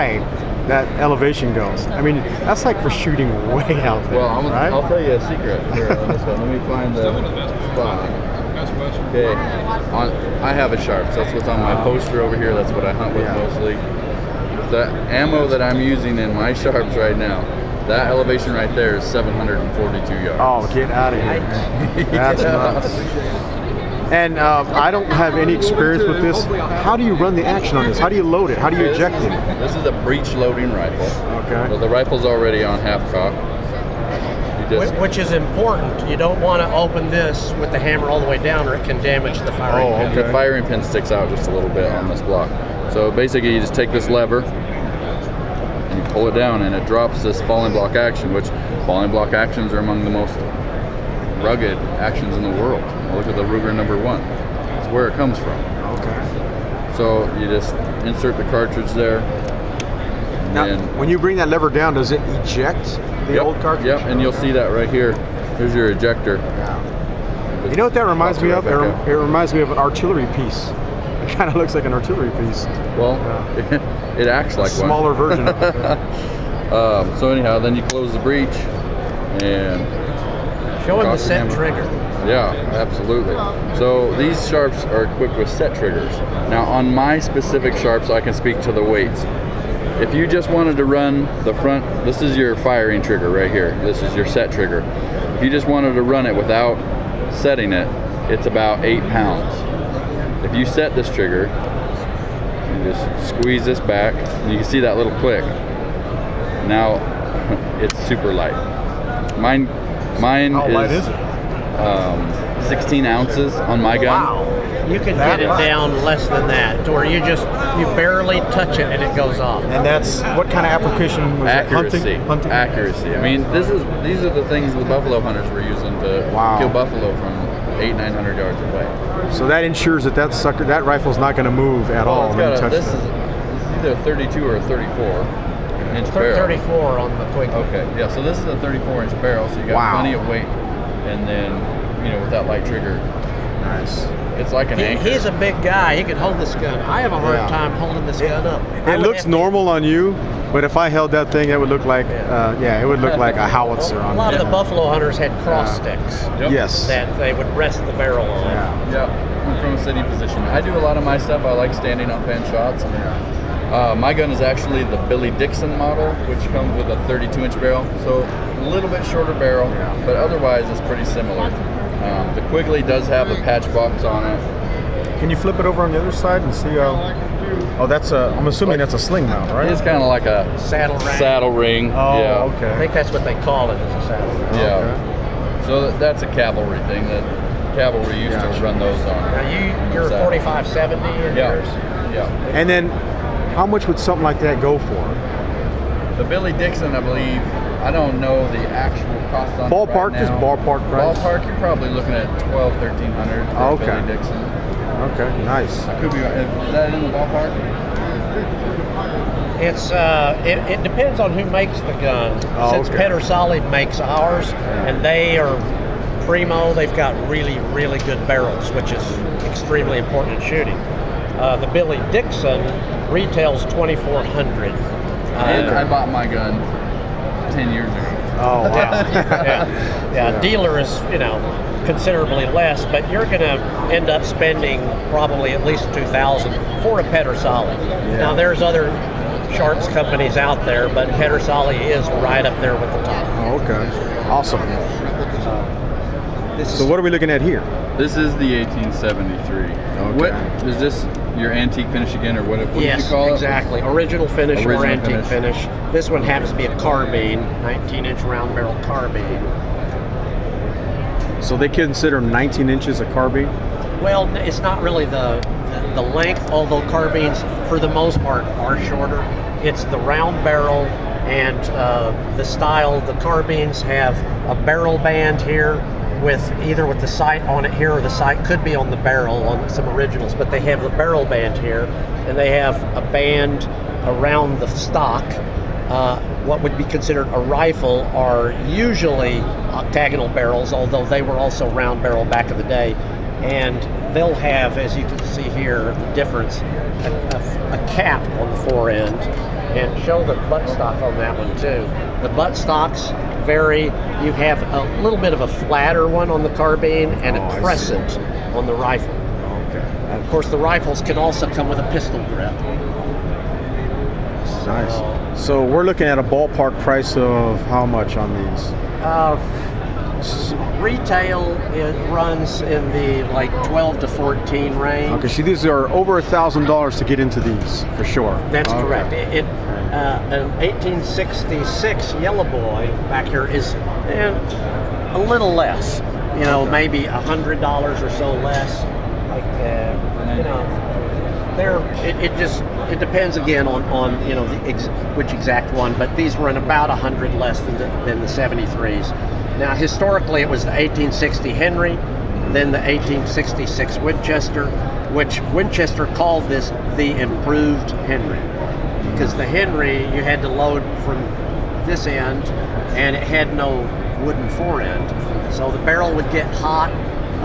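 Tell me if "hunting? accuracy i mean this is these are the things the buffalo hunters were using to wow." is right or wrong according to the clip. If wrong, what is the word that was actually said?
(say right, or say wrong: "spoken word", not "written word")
right.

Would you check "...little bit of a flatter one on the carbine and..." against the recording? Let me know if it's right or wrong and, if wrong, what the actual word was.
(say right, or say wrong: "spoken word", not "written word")
right.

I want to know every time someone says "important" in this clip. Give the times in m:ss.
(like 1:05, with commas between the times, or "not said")
0:35, 3:39.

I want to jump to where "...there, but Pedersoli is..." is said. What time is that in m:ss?
4:00.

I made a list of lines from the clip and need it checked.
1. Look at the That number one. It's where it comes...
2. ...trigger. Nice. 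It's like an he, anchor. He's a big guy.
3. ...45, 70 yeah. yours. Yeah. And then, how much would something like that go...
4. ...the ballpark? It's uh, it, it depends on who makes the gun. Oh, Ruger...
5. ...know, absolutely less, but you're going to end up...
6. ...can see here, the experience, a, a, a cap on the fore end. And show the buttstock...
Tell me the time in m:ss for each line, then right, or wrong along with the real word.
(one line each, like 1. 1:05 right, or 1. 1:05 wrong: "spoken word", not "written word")
1. 0:53 wrong: "Ruger", not "That"
2. 2:22 right
3. 3:10 right
4. 3:27 wrong: "Since", not "Ruger"
5. 3:51 wrong: "considerably", not "absolutely"
6. 4:55 wrong: "difference", not "experience".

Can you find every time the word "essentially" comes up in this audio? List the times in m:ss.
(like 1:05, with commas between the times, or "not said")
not said.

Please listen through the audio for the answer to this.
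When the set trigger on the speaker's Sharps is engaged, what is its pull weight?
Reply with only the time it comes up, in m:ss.
1:52.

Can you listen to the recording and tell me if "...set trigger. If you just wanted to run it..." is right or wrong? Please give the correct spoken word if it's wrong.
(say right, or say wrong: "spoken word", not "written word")
right.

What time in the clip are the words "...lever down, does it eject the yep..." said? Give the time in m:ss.
1:01.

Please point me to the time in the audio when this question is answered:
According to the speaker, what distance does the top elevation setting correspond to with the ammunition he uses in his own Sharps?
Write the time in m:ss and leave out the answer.
0:19.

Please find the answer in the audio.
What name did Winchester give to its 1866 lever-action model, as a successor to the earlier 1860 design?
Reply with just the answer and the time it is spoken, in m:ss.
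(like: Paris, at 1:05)
improved Henry, at 5:57.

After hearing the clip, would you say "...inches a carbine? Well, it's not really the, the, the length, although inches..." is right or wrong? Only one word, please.
wrong.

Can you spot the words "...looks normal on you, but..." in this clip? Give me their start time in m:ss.
2:28.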